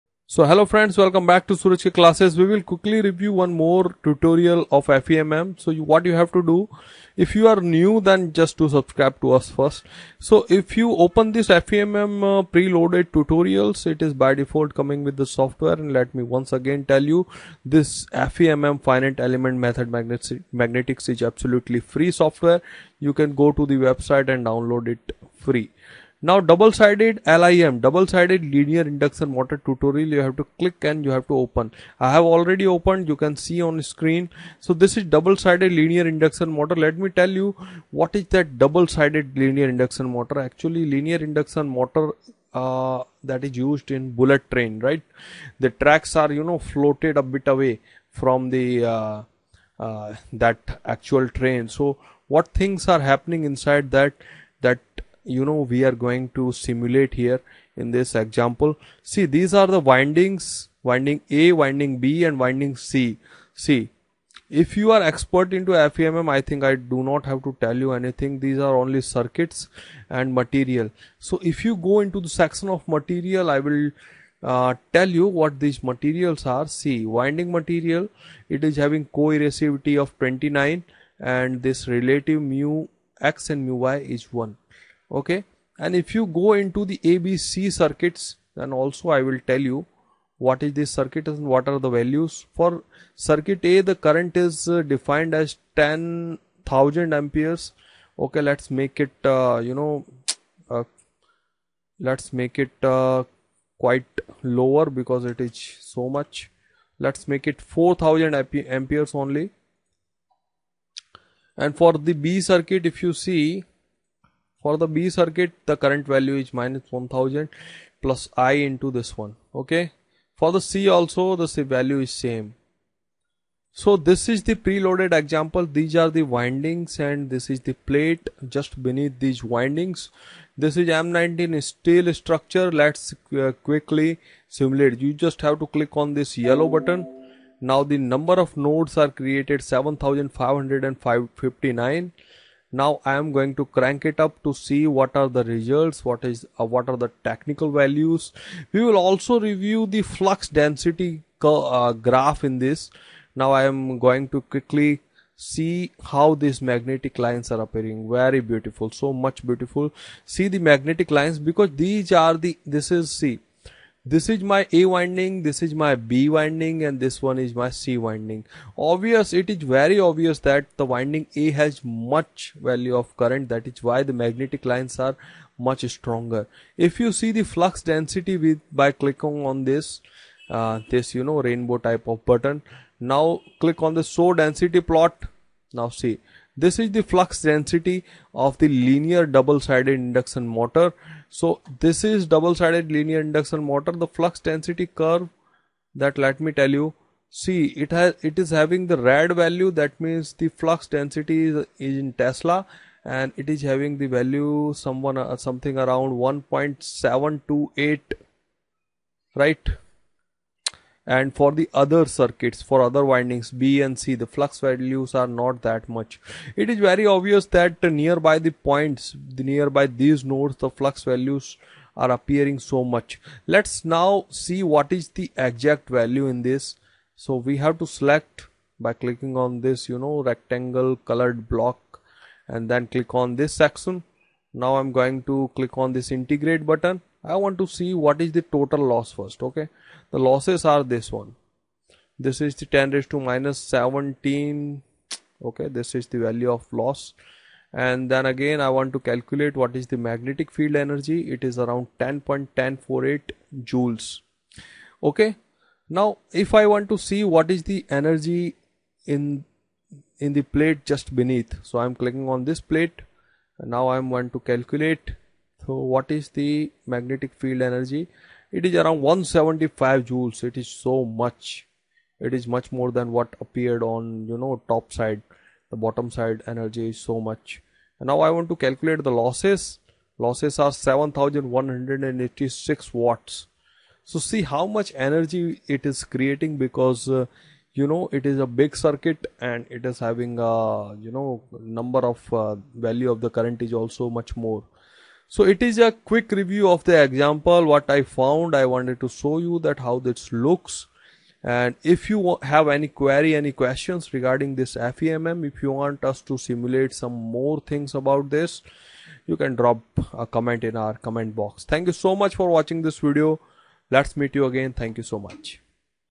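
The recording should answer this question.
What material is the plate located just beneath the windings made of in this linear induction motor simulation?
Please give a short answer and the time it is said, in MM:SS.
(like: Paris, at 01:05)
M19 steel, at 02:10.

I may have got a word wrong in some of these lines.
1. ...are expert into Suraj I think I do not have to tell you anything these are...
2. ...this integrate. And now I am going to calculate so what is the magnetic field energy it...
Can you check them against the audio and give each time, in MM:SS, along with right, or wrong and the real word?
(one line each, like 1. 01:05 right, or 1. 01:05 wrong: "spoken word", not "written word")
1. 01:04 wrong: "FEMM", not "Suraj"
2. 04:22 wrong: "plate", not "integrate".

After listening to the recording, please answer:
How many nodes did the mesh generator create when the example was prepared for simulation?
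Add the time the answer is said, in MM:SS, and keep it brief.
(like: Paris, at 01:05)
7559, at 02:19.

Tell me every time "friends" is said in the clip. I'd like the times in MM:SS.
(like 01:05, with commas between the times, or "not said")
00:00.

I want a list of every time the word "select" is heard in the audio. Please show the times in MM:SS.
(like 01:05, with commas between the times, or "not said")
03:47.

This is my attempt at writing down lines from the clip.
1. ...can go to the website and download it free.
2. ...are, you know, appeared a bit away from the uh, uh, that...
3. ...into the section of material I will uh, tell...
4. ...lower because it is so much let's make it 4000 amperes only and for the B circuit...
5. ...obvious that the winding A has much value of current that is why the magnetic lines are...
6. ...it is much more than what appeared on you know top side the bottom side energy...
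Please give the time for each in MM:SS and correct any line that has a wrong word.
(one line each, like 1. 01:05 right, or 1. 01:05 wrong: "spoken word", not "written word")
1. 00:23 right
2. 00:46 wrong: "floated", not "appeared"
3. 01:11 right
4. 01:44 right
5. 02:49 right
6. 04:32 right.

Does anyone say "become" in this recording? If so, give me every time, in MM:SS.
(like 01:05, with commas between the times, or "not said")
not said.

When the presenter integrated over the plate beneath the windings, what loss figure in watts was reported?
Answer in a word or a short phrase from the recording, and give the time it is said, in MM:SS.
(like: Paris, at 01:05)
7186 watts, at 04:40.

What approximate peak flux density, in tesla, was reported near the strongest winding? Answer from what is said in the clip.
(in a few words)
1.728.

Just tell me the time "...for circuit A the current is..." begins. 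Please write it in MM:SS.
01:32.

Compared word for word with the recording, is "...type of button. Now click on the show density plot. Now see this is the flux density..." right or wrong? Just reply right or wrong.
right.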